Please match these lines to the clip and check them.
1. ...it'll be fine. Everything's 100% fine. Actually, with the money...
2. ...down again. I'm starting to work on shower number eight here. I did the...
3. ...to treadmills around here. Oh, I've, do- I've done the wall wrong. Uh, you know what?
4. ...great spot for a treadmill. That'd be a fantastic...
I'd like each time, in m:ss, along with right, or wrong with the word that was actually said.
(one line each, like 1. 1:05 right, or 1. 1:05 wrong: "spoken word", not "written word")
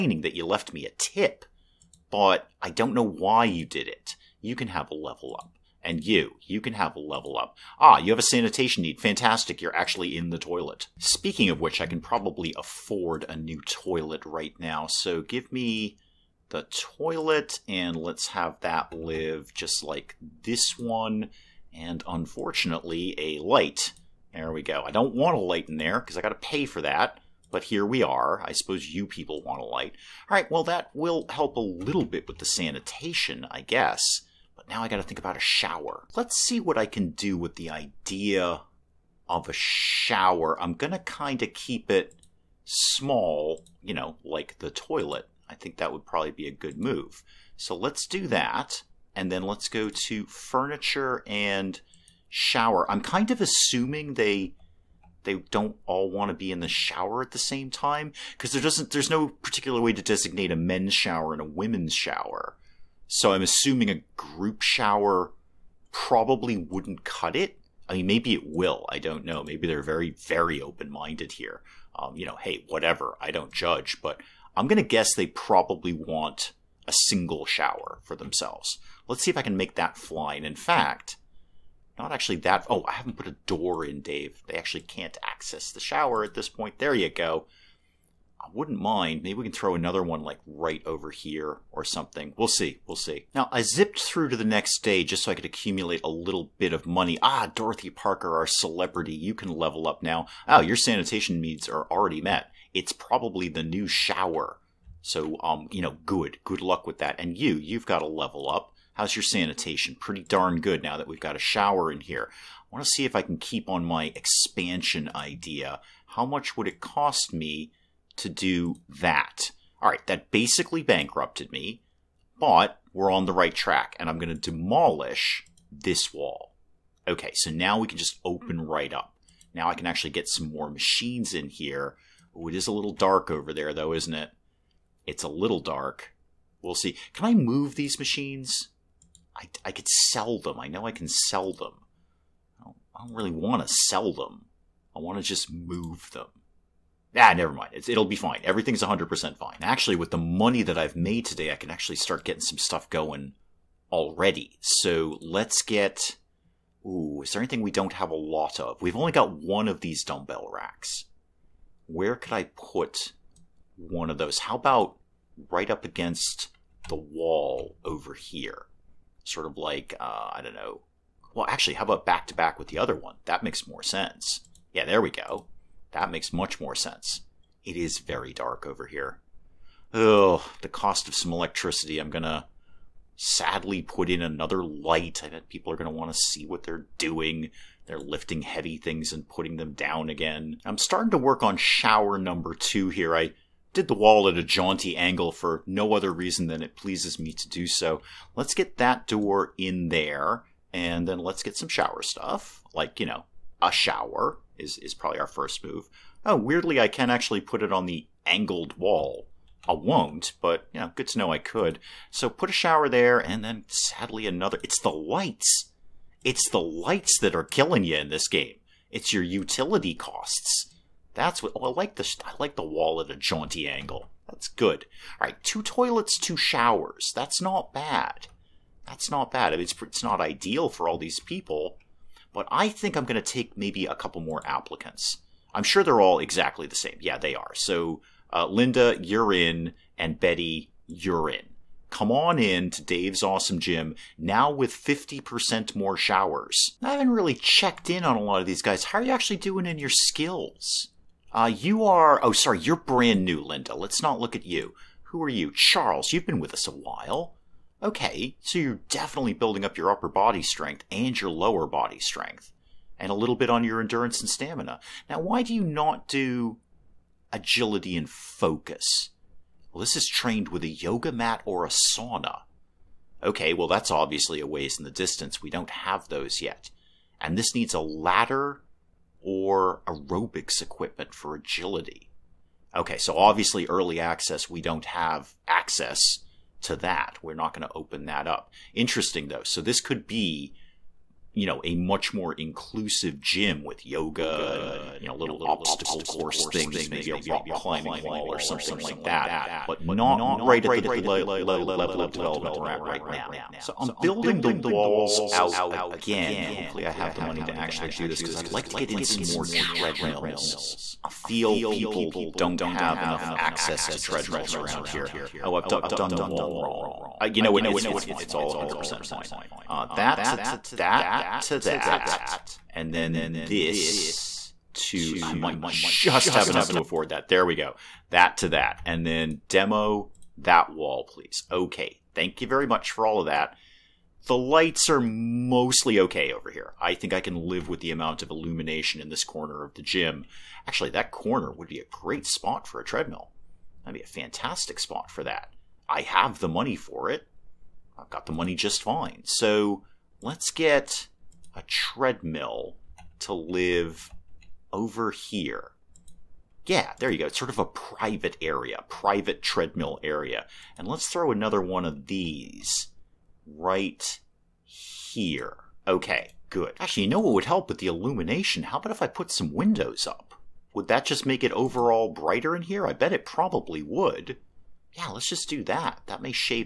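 1. 2:27 right
2. 3:09 wrong: "two", not "eight"
3. 5:13 right
4. 5:41 right.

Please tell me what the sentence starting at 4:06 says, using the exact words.
I haven't really checked in on a lot of these guys.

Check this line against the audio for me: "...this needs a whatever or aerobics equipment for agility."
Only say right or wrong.
wrong.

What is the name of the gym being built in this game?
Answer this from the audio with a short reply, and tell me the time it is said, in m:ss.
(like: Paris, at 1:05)
Dave's Awesome Gym, at 4:02.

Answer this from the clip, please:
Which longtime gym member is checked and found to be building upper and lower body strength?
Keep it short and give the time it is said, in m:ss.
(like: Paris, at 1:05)
Charles, at 4:15.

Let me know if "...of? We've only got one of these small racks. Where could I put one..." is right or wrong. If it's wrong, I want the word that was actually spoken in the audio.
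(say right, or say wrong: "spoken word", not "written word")
wrong: "dumbbell", not "small".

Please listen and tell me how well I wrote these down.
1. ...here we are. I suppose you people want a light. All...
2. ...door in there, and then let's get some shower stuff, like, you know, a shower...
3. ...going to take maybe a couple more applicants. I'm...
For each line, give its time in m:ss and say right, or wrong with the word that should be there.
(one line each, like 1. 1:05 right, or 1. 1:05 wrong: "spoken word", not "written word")
1. 0:27 right
2. 3:19 right
3. 3:53 right.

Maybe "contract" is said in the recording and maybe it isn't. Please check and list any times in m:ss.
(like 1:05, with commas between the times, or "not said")
not said.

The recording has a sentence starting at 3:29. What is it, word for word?
I won't, but you know, good to know I could.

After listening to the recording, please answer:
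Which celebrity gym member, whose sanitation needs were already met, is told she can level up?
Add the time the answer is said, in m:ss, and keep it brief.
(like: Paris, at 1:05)
Dorothy Parker, at 1:37.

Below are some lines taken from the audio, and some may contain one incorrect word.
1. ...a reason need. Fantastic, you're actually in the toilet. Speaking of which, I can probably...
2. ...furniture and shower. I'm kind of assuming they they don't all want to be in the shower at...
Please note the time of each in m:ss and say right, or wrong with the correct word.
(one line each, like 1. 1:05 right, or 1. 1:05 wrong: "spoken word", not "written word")
1. 0:08 wrong: "sanitation", not "reason"
2. 0:50 right.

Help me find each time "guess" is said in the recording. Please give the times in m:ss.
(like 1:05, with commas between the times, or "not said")
0:33, 1:14.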